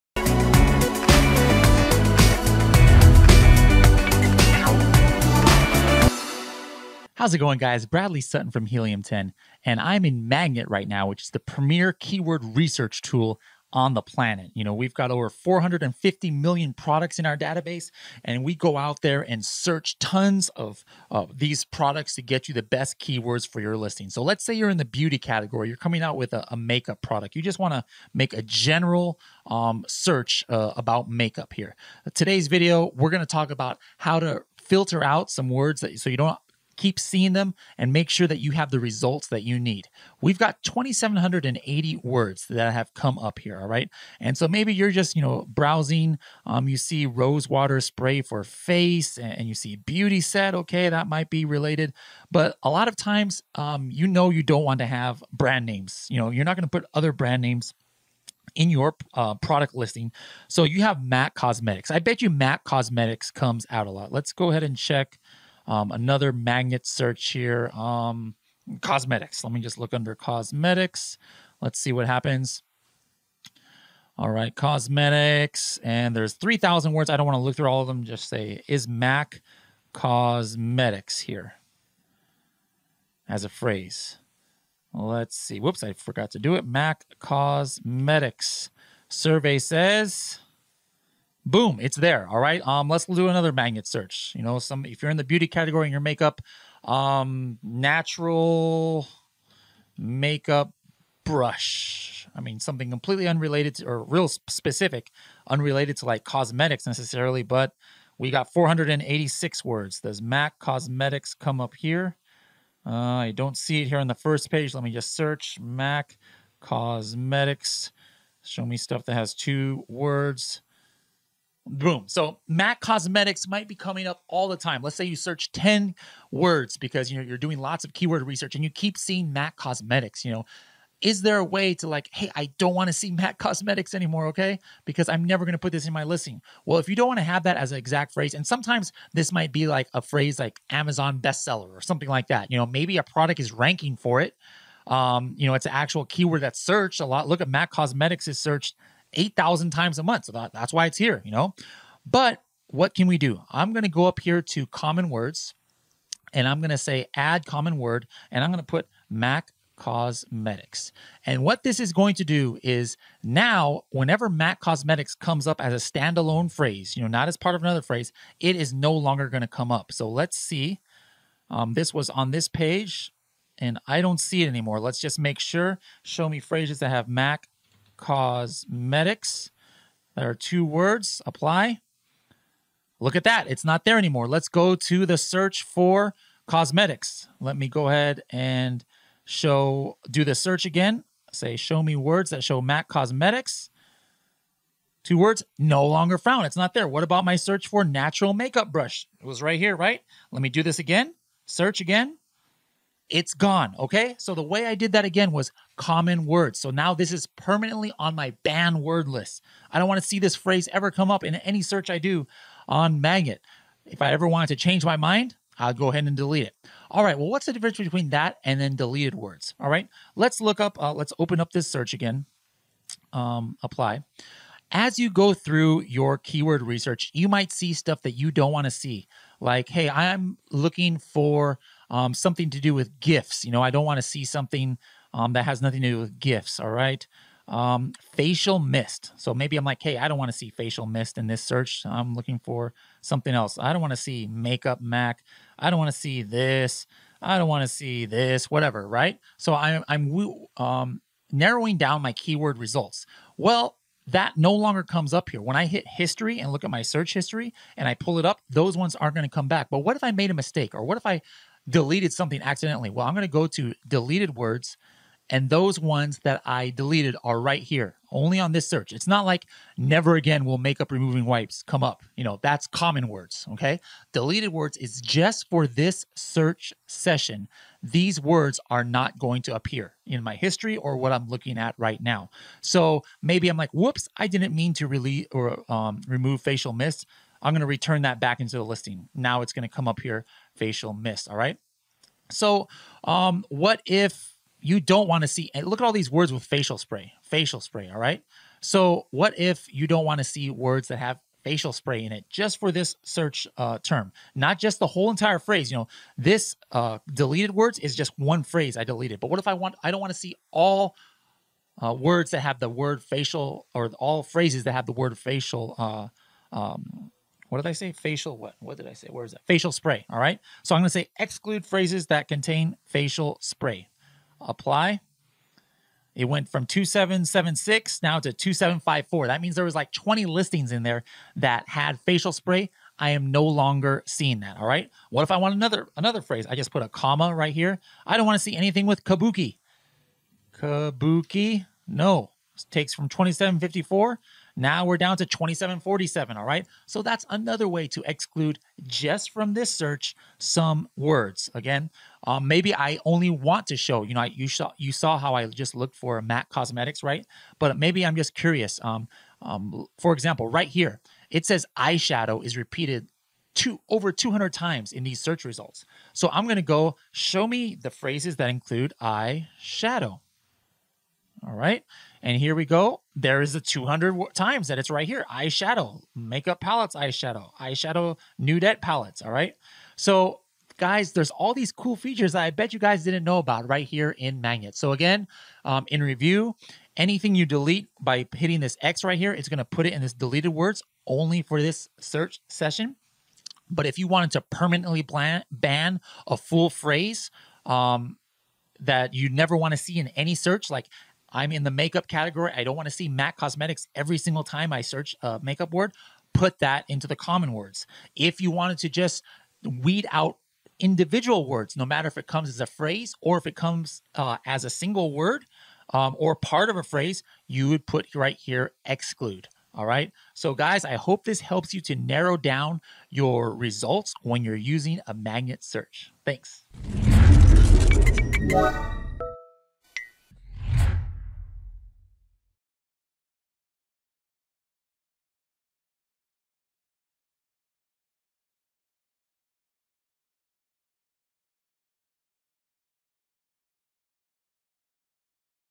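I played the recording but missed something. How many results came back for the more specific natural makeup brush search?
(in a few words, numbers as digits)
486.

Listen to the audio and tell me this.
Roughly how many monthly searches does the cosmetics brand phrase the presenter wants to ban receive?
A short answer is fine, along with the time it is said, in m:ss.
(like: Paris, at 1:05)
8,000, at 2:29.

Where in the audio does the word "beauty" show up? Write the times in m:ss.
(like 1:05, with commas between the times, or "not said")
0:24, 0:49, 1:35.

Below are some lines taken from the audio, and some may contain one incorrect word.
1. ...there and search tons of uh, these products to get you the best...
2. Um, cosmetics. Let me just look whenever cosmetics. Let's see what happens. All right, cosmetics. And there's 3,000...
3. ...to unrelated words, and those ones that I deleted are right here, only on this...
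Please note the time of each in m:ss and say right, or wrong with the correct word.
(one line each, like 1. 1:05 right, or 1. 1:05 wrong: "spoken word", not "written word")
1. 0:19 right
2. 1:07 wrong: "under", not "whenever"
3. 4:23 wrong: "deleted", not "unrelated".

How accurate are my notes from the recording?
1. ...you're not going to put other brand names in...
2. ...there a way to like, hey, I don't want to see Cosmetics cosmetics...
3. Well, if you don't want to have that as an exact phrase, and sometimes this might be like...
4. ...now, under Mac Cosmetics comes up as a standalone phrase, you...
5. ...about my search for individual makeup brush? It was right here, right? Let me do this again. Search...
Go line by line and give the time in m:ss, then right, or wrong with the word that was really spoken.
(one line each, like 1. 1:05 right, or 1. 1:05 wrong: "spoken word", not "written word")
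1. 0:56 right
2. 2:11 wrong: "MAC", not "Cosmetics"
3. 2:16 right
4. 2:43 wrong: "whenever", not "under"
5. 3:17 wrong: "natural", not "individual".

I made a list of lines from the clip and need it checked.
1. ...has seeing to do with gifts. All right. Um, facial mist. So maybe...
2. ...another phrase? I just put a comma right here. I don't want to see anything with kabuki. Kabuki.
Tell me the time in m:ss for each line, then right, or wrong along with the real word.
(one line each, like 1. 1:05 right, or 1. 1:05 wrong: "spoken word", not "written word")
1. 3:55 wrong: "nothing", not "seeing"
2. 5:35 right.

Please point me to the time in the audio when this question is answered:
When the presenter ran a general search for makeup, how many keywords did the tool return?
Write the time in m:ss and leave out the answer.
0:40.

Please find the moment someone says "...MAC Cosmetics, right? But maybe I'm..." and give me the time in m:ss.
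5:56.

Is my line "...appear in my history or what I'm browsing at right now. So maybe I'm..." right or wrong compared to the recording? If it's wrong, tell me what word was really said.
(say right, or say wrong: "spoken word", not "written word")
wrong: "looking", not "browsing".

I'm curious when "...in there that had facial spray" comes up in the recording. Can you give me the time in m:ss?
5:30.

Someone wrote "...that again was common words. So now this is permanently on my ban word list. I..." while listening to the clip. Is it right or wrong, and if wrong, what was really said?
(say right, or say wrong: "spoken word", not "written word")
right.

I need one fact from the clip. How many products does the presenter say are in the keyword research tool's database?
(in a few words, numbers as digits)
450 million.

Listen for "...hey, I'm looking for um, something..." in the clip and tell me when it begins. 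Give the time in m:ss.
3:49.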